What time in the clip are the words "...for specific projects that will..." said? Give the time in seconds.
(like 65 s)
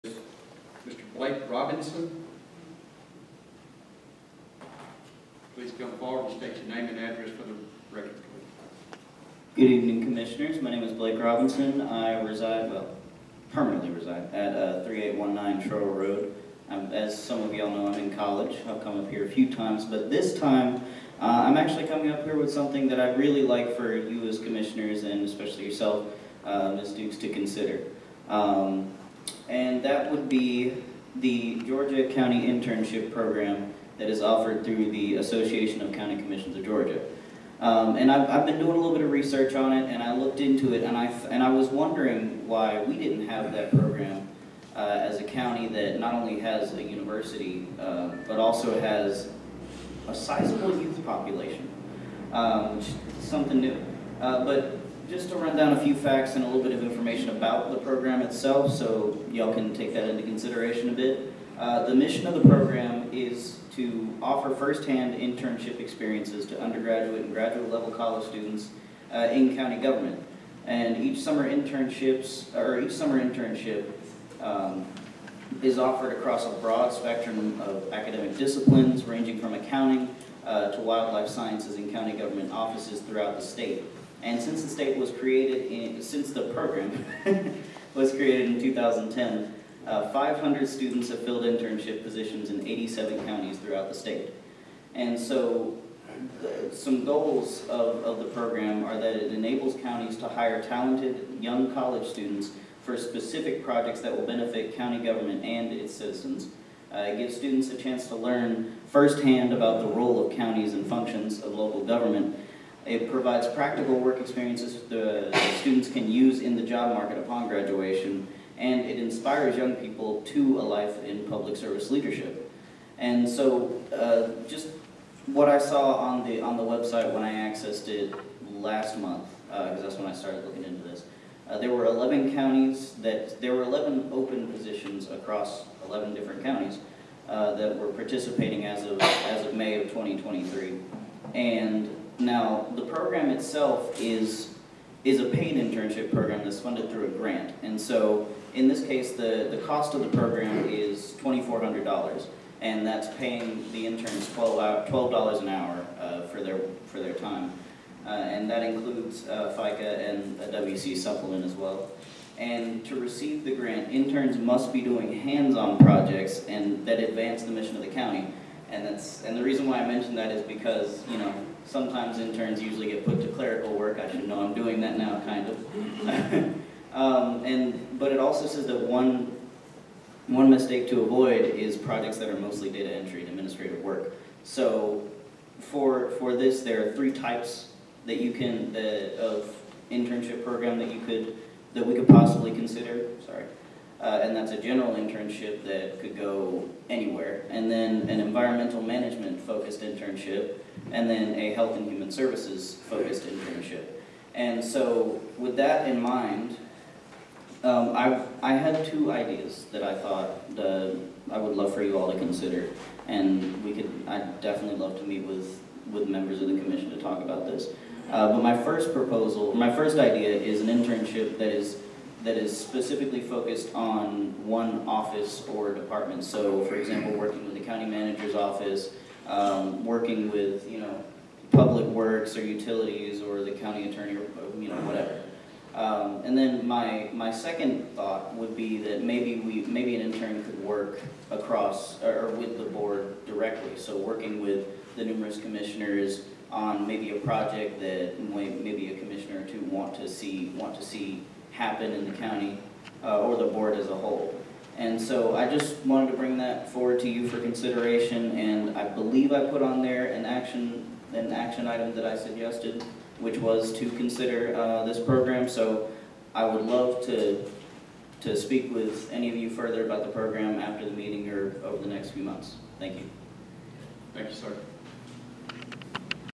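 102 s.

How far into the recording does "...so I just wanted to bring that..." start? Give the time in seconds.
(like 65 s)
254 s.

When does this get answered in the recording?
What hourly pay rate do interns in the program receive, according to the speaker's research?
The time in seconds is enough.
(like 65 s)
154 s.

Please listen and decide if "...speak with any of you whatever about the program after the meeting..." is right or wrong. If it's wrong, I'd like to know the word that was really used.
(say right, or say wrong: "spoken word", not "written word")
wrong: "further", not "whatever".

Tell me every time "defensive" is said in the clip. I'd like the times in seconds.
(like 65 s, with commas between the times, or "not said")
not said.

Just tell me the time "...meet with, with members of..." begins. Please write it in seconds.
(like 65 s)
215 s.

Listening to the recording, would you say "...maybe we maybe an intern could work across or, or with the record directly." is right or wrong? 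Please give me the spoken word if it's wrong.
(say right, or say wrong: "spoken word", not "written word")
wrong: "board", not "record".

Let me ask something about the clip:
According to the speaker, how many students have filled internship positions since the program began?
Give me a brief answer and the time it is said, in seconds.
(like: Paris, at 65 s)
500, at 90 s.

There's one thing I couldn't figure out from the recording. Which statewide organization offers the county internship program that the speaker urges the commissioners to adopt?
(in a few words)
Association of County Commissions of Georgia.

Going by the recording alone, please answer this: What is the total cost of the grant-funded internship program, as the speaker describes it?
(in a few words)
$2,400.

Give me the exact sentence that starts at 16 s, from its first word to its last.
I'm, as some of y'all know, I'm in college.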